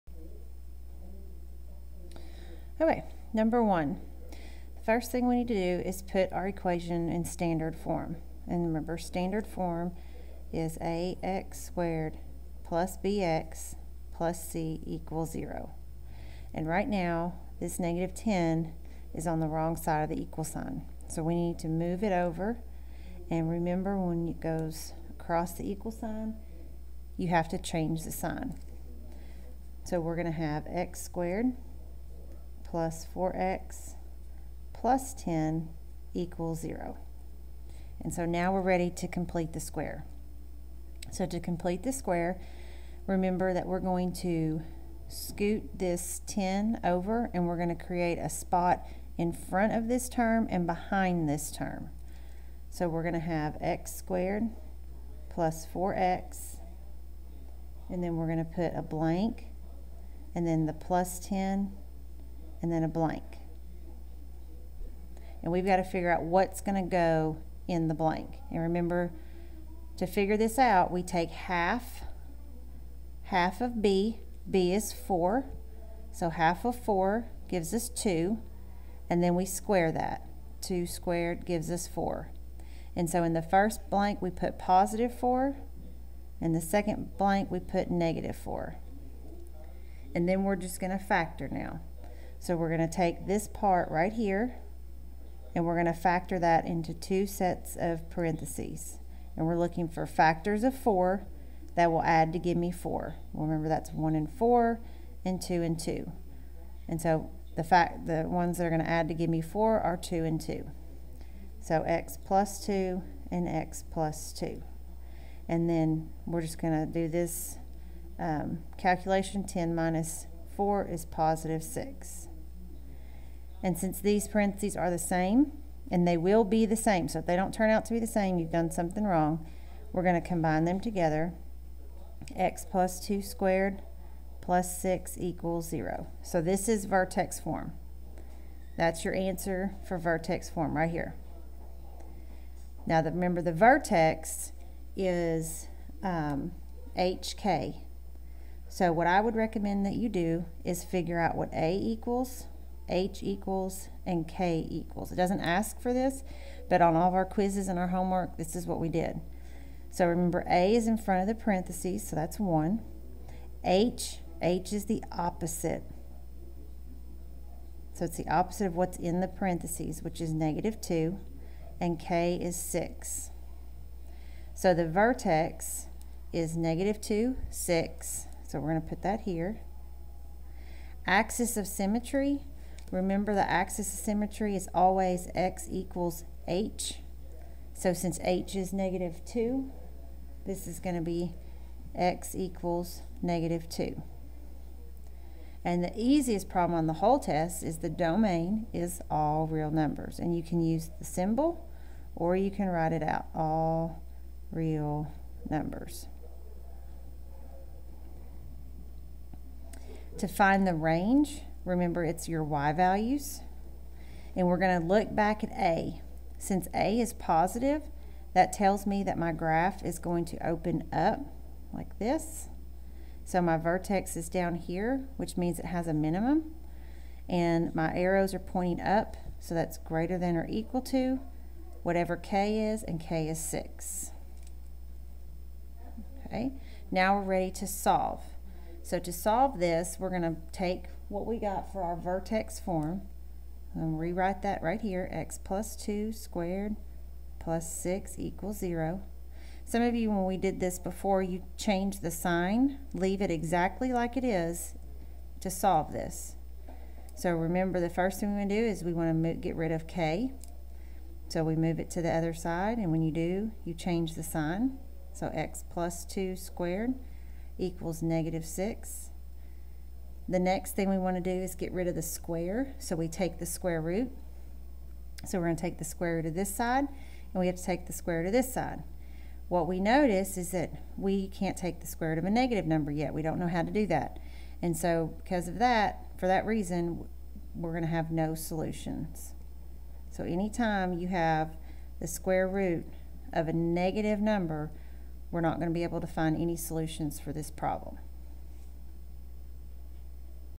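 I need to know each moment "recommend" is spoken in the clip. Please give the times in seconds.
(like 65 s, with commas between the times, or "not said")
149 s.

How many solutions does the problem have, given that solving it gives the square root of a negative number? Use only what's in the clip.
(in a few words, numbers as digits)
no solutions.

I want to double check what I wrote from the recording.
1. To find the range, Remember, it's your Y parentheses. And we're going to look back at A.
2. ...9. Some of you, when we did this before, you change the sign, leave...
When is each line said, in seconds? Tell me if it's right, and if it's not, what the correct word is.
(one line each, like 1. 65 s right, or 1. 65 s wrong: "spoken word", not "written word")
1. 210 s wrong: "values", not "parentheses"
2. 248 s wrong: "0", not "9".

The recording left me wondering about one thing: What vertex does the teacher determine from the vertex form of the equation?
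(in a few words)
(-2, 6).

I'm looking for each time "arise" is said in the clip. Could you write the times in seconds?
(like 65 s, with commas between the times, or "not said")
not said.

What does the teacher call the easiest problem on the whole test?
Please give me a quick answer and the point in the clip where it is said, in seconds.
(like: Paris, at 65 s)
the domain, at 197 s.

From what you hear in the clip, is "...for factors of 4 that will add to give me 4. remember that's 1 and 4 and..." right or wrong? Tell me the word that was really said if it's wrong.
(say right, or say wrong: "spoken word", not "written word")
right.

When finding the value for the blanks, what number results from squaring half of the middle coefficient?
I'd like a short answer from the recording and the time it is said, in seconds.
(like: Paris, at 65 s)
4, at 80 s.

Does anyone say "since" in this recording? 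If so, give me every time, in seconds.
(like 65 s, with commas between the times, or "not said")
123 s, 187 s, 216 s.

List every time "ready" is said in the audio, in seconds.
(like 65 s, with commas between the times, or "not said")
38 s, 237 s.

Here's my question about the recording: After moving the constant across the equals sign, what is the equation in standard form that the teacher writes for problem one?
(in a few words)
x^2 + 4x + 10 = 0.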